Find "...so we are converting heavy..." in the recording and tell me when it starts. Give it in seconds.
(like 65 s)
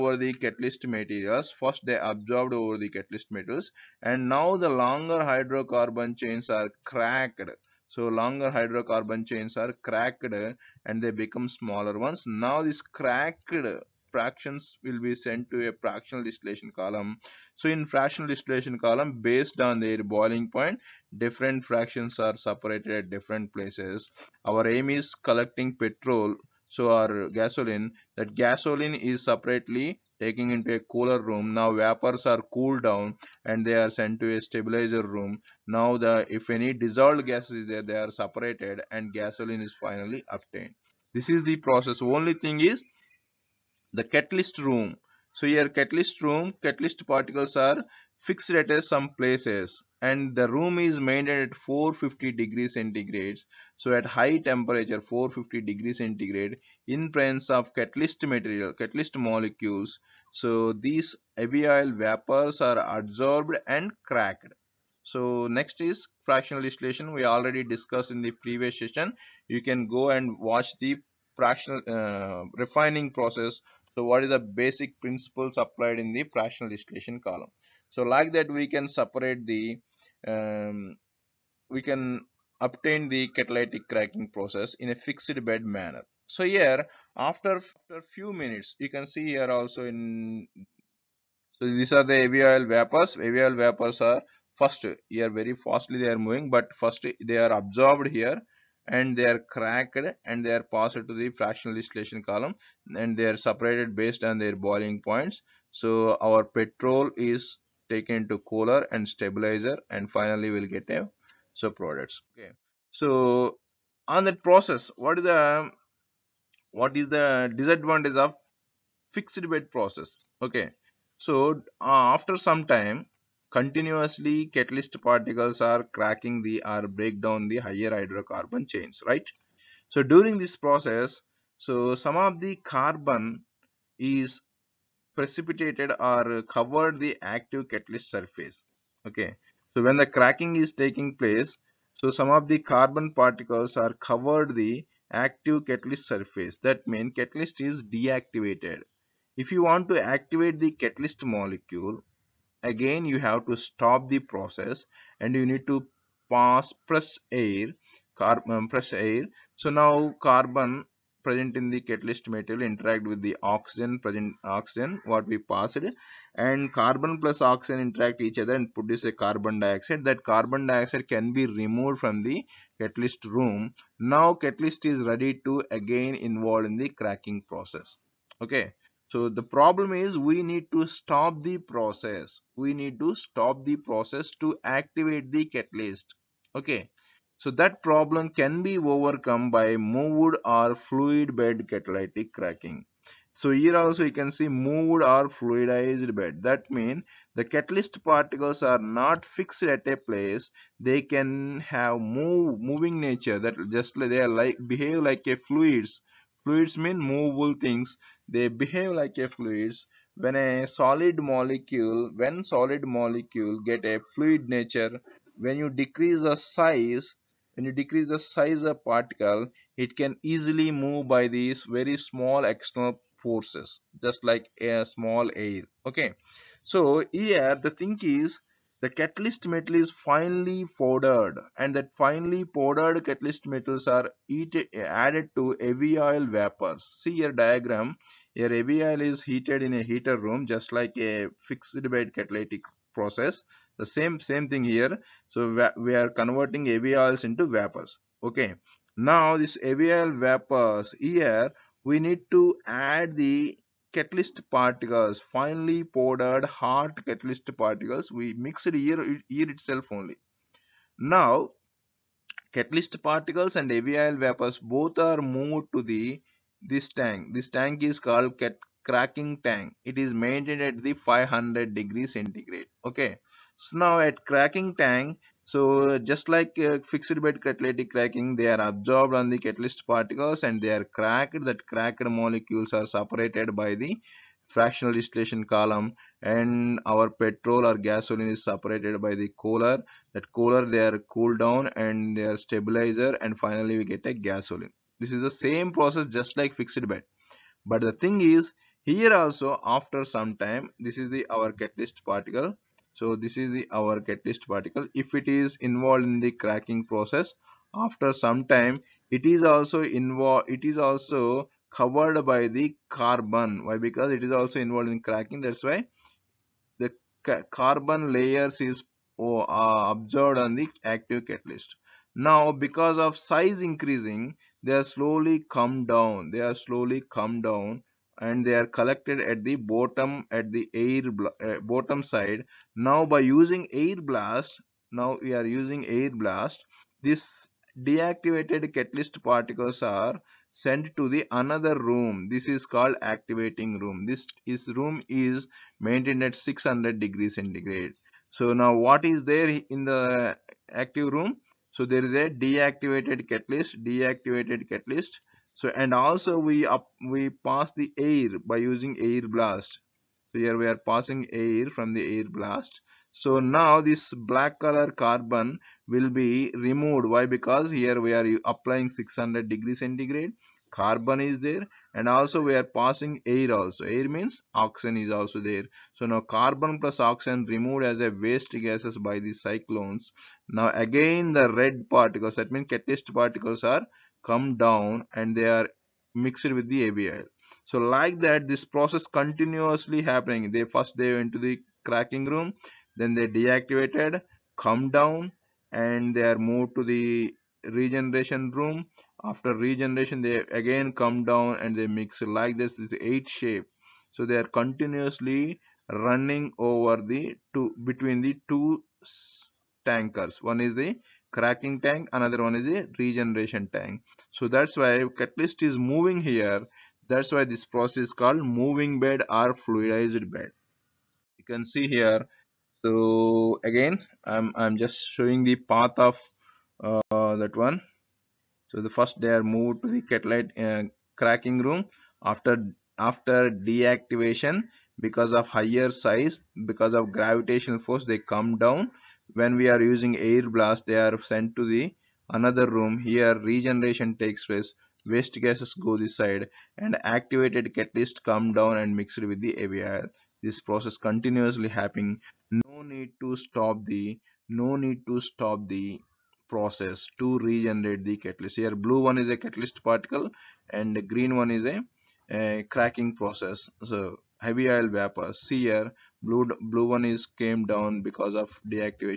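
245 s.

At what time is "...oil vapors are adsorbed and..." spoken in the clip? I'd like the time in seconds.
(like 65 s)
61 s.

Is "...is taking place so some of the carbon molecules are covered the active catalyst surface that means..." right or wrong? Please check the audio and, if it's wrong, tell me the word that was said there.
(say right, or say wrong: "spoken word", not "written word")
wrong: "particles", not "molecules".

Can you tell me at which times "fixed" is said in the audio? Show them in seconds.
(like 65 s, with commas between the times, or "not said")
48 s, 84 s, 119 s, 199 s, 241 s, 276 s, 296 s.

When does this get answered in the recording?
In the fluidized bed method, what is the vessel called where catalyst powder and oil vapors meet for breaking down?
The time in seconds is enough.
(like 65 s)
268 s.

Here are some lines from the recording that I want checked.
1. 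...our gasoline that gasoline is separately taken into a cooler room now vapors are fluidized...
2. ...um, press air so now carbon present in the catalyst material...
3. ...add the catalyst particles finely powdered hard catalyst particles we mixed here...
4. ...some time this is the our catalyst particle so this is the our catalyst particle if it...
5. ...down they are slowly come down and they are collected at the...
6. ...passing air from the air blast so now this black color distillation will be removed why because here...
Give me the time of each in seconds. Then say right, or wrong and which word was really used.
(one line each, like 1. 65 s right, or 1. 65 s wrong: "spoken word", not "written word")
1. 26 s wrong: "cooled", not "fluidized"
2. 158 s right
3. 252 s right
4. 300 s right
5. 325 s right
6. 360 s wrong: "carbon", not "distillation".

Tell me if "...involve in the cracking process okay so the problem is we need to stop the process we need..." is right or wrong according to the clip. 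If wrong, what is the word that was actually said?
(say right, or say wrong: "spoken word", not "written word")
right.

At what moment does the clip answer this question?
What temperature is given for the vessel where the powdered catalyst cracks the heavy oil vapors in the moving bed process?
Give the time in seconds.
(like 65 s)
270 s.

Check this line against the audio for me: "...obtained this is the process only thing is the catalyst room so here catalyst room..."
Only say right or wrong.
right.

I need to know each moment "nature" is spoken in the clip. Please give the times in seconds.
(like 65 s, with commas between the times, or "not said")
203 s, 214 s.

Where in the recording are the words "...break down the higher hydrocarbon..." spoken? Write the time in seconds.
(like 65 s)
126 s.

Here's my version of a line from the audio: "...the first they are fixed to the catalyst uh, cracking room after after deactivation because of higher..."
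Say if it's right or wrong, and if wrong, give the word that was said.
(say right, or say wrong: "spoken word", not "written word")
wrong: "moved", not "fixed".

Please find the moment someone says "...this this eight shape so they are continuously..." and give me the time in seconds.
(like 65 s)
402 s.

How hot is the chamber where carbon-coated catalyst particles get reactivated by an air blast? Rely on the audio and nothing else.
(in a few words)
600 degrees centigrade.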